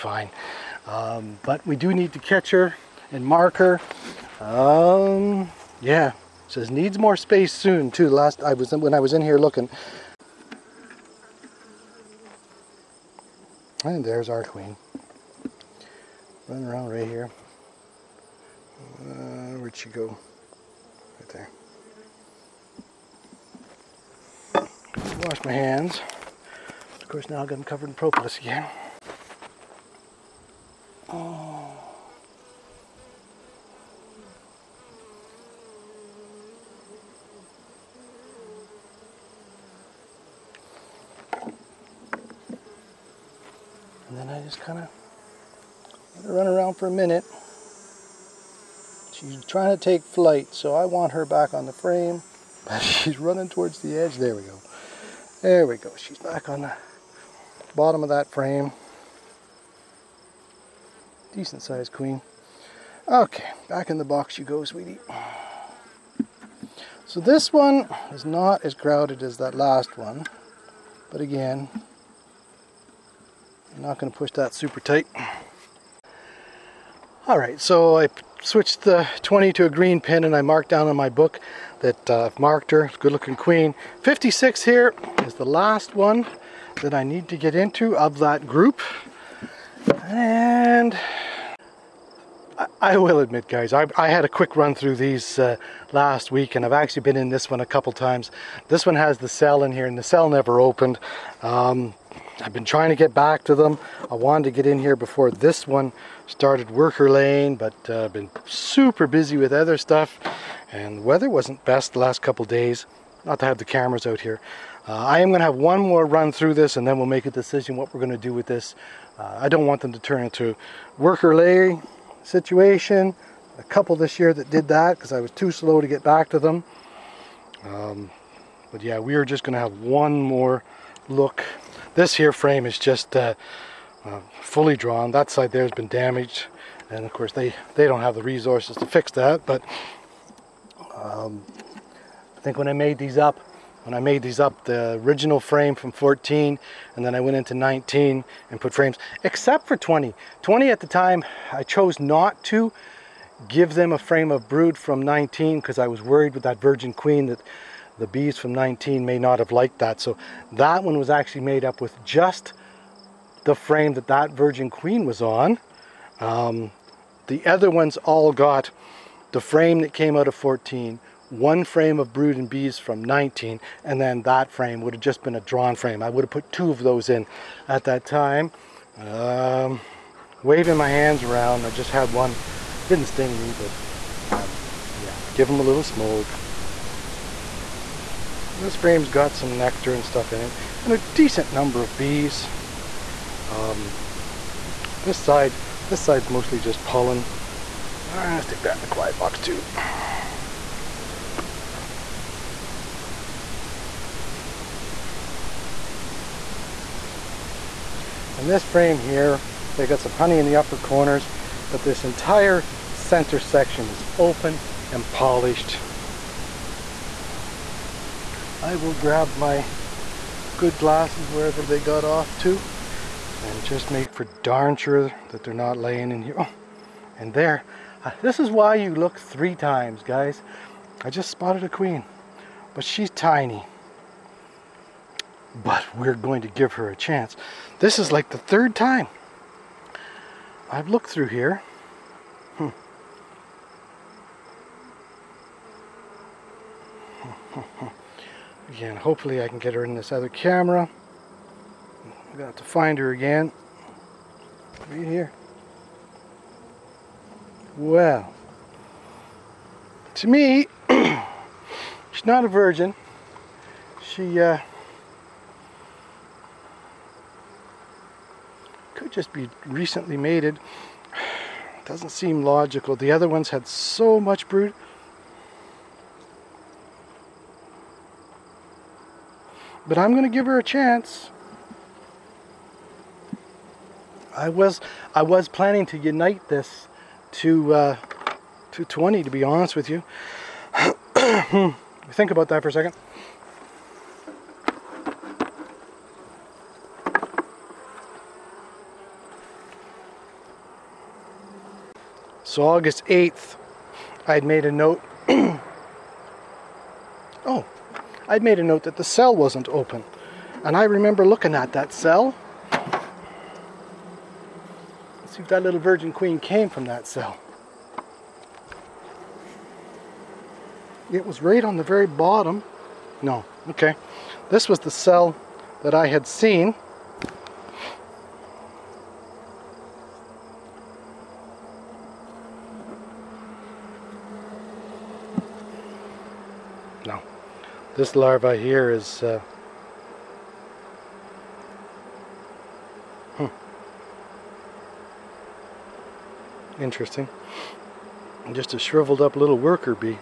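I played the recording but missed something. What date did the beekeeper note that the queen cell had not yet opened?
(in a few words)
August 8th.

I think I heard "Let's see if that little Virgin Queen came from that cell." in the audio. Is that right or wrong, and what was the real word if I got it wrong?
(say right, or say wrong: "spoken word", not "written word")
right.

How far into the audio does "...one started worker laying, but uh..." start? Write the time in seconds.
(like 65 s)
105 s.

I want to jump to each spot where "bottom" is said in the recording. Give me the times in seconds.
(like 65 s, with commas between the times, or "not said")
57 s, 322 s.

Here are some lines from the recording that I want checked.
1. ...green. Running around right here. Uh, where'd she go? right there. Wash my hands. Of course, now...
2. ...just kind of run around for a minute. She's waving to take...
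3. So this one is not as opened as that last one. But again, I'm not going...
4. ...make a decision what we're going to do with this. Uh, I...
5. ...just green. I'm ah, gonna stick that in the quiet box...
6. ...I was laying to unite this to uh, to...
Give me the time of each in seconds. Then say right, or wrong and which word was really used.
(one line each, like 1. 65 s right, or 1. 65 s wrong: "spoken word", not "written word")
1. 14 s wrong: "queen", not "green"
2. 44 s wrong: "trying", not "waving"
3. 67 s wrong: "crowded", not "opened"
4. 117 s right
5. 196 s wrong: "pollen", not "green"
6. 285 s wrong: "planning", not "laying".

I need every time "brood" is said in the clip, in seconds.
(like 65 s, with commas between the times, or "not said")
154 s, 172 s, 274 s.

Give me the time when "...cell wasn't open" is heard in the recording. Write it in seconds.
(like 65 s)
309 s.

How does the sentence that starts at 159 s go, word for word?
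So that one was actually made up with just the frame that that Virgin Queen was on.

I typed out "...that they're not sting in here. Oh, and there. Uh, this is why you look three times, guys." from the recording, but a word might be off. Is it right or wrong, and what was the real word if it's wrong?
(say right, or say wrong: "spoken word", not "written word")
wrong: "laying", not "sting".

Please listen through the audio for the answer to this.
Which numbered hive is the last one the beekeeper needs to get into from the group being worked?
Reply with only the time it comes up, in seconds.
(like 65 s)
84 s.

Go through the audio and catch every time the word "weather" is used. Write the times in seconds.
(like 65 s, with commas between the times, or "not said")
111 s.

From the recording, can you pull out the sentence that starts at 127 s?
Um, but yeah, we are just going to have one more look this here frame is just uh, uh, fully drawn.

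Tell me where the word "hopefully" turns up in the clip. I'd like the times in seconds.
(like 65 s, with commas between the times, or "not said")
248 s.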